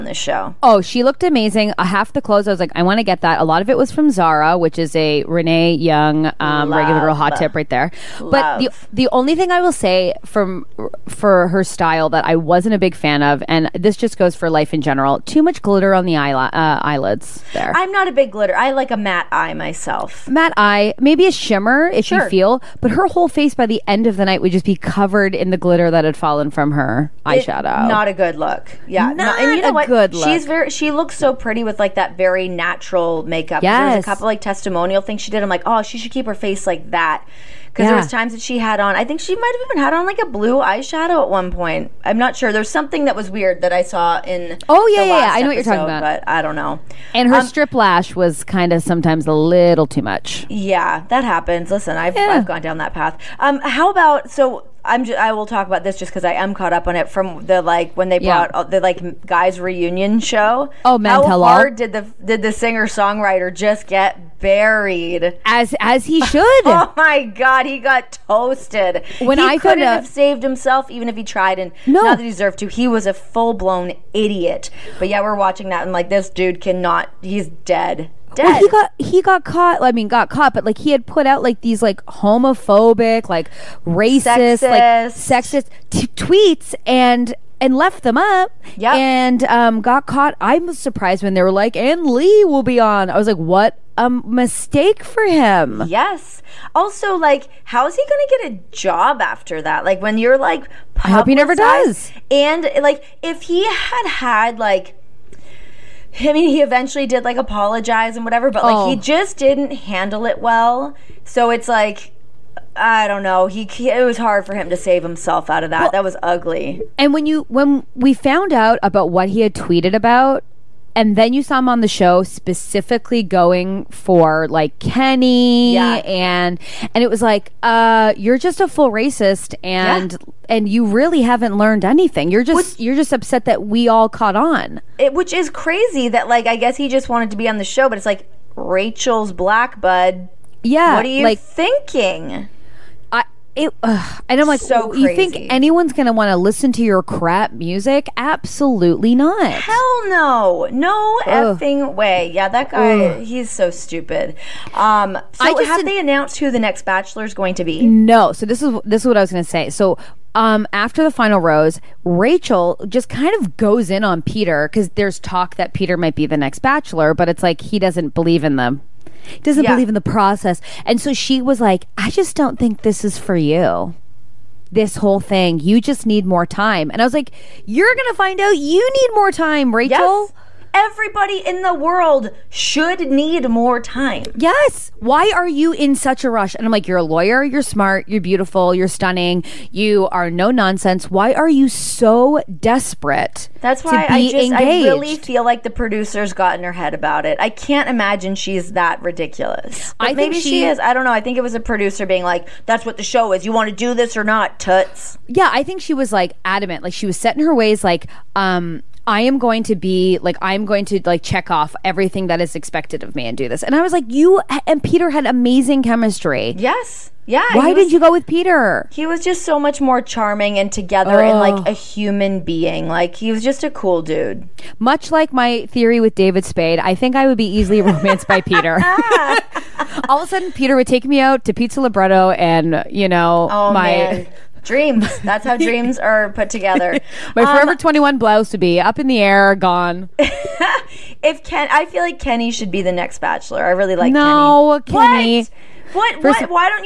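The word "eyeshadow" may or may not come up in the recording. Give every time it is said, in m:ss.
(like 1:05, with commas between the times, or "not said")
0:27, 0:40.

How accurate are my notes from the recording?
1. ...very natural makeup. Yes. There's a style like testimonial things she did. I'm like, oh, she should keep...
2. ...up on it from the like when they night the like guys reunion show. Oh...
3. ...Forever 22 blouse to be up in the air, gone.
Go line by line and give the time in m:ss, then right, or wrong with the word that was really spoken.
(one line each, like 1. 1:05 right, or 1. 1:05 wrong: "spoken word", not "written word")
1. 0:32 wrong: "couple", not "style"
2. 0:56 wrong: "brought", not "night"
3. 3:57 wrong: "21", not "22".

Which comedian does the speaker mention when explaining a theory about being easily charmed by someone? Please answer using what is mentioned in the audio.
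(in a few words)
David Spade.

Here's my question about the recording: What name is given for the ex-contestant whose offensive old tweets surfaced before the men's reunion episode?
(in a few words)
Lee.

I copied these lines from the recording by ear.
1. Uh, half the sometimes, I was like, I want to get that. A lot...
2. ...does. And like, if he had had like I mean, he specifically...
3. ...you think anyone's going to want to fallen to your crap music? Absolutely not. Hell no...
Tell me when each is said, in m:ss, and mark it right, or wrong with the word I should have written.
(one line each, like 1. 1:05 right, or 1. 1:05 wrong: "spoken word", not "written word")
1. 0:01 wrong: "clothes", not "sometimes"
2. 1:41 wrong: "eventually", not "specifically"
3. 2:24 wrong: "listen", not "fallen".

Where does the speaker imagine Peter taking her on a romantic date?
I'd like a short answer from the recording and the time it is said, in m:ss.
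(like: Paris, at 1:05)
Pizza Libretto, at 3:51.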